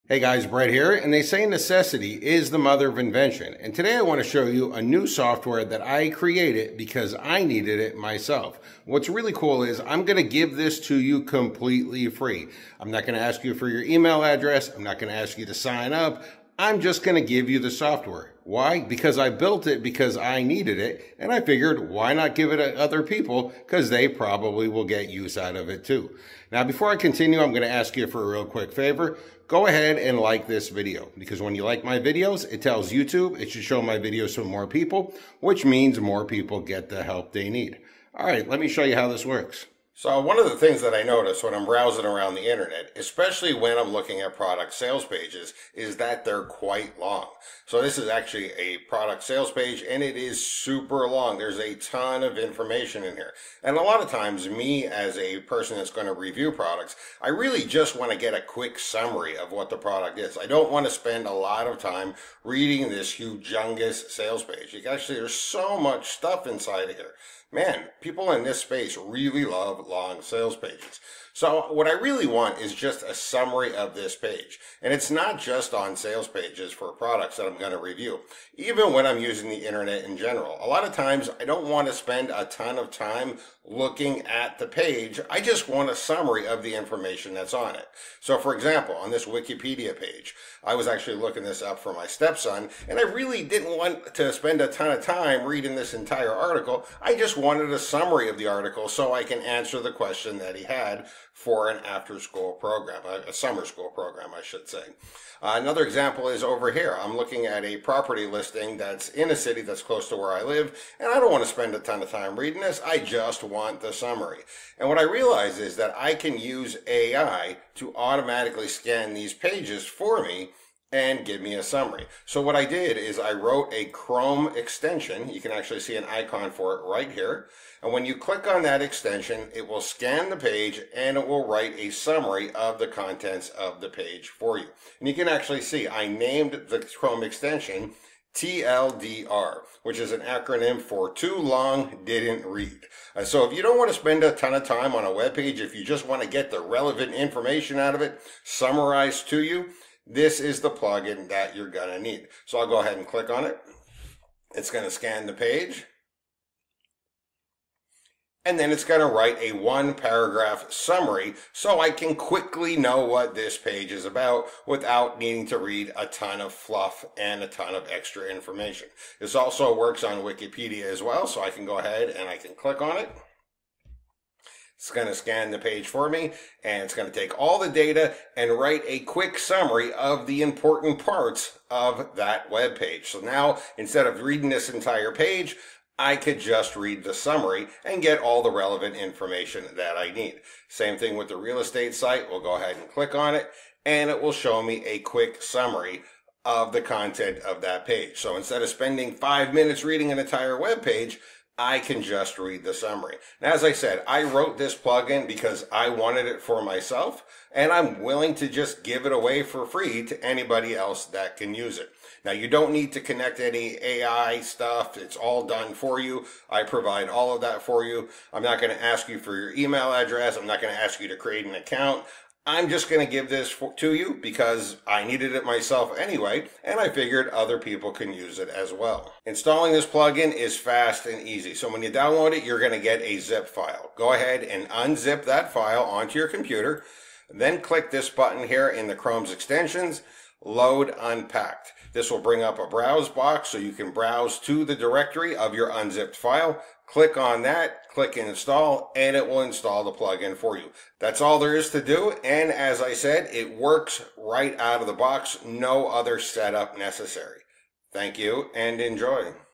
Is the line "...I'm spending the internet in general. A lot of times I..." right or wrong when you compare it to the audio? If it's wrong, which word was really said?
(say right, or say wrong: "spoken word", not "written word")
wrong: "using", not "spending".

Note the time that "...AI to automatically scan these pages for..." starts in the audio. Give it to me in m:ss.
1:56.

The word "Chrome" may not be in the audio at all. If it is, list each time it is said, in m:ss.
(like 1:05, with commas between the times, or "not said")
2:03, 2:16, 3:58.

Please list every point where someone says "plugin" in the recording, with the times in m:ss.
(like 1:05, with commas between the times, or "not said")
2:30, 3:24, 3:49, 4:09.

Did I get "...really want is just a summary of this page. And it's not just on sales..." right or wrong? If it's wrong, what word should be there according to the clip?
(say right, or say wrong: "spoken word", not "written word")
right.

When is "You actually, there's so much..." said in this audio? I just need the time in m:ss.
1:04.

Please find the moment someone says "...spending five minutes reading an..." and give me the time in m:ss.
3:18.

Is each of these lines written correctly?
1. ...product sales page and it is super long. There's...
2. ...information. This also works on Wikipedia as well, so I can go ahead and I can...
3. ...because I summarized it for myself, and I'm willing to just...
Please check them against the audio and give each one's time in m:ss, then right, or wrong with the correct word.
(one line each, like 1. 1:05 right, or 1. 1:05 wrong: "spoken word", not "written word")
1. 0:48 right
2. 2:48 right
3. 3:25 wrong: "wanted", not "summarized".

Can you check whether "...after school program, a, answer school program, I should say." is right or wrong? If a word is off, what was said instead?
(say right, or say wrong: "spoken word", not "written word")
wrong: "summer", not "answer".